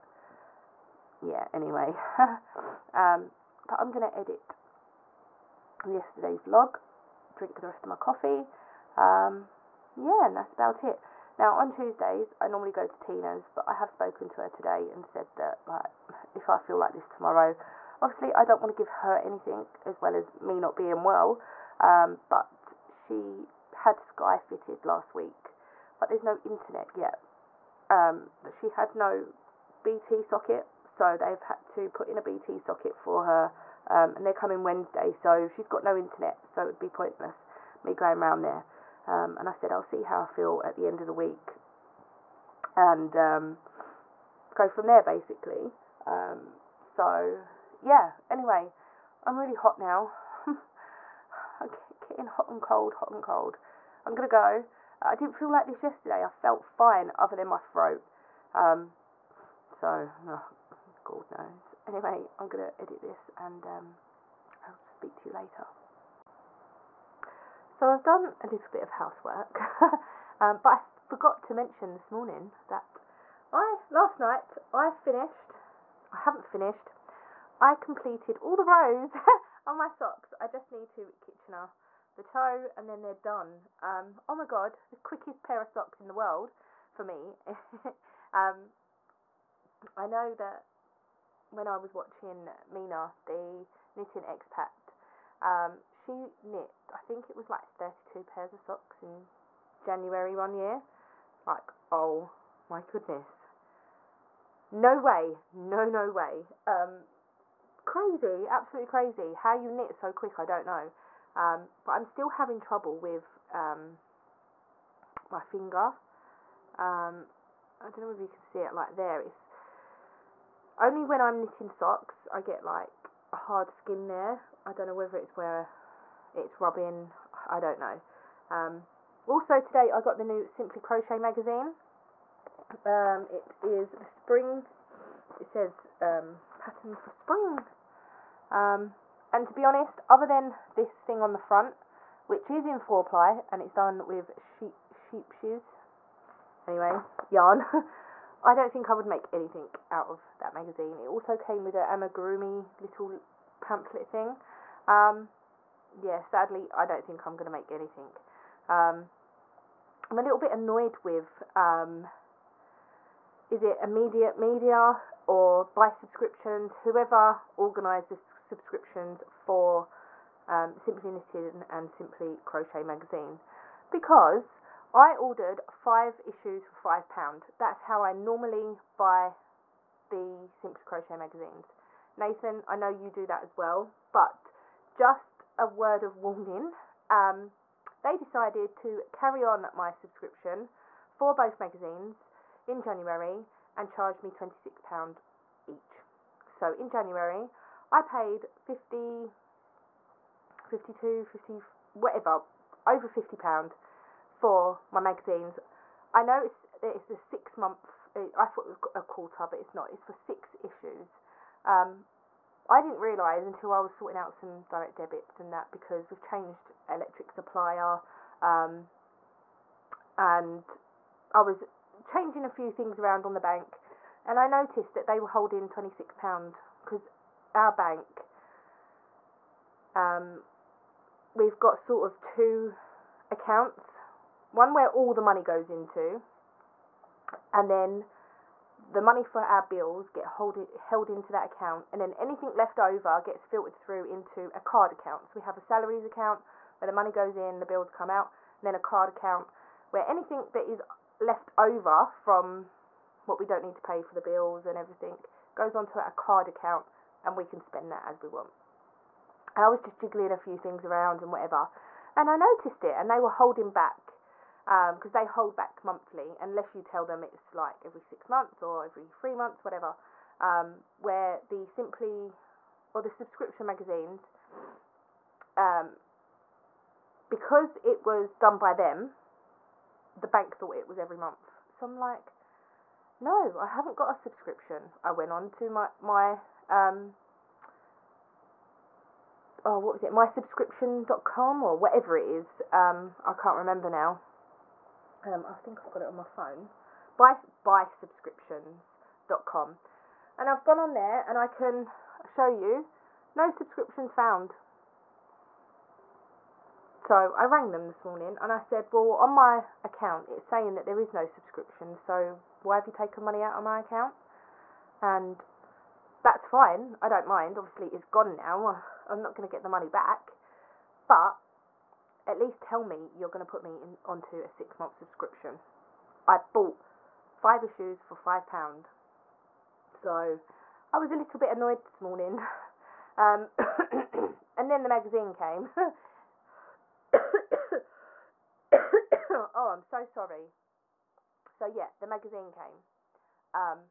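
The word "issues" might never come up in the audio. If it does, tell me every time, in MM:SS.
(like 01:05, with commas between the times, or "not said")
02:56, 03:30, 05:27.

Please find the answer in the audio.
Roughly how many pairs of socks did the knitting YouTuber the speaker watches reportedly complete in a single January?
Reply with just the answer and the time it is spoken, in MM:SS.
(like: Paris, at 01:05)
32, at 01:37.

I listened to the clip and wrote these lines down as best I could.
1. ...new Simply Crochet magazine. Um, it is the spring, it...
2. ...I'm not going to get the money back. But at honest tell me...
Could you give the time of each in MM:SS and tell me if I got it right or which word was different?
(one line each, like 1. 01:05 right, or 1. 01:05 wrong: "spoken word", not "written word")
1. 02:10 right
2. 05:19 wrong: "least", not "honest".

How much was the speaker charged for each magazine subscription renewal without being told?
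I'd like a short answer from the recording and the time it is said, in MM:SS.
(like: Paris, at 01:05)
£26, at 03:14.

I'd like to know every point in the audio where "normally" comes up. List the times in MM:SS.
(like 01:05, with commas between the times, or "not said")
00:12, 02:58.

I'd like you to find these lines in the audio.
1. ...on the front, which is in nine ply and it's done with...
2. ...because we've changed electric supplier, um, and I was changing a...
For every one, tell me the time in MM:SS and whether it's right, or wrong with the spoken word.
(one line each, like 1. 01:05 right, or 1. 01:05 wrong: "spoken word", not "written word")
1. 02:21 wrong: "four", not "nine"
2. 03:35 right.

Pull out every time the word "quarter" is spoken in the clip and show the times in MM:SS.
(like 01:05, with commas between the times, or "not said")
03:29.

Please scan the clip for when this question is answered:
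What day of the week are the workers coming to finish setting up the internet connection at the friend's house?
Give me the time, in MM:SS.
00:34.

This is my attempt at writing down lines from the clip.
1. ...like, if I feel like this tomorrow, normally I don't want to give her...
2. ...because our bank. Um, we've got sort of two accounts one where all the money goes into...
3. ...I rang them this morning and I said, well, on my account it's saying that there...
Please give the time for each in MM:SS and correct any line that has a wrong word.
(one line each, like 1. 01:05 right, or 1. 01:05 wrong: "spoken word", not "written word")
1. 00:15 wrong: "obviously", not "normally"
2. 03:46 right
3. 05:07 right.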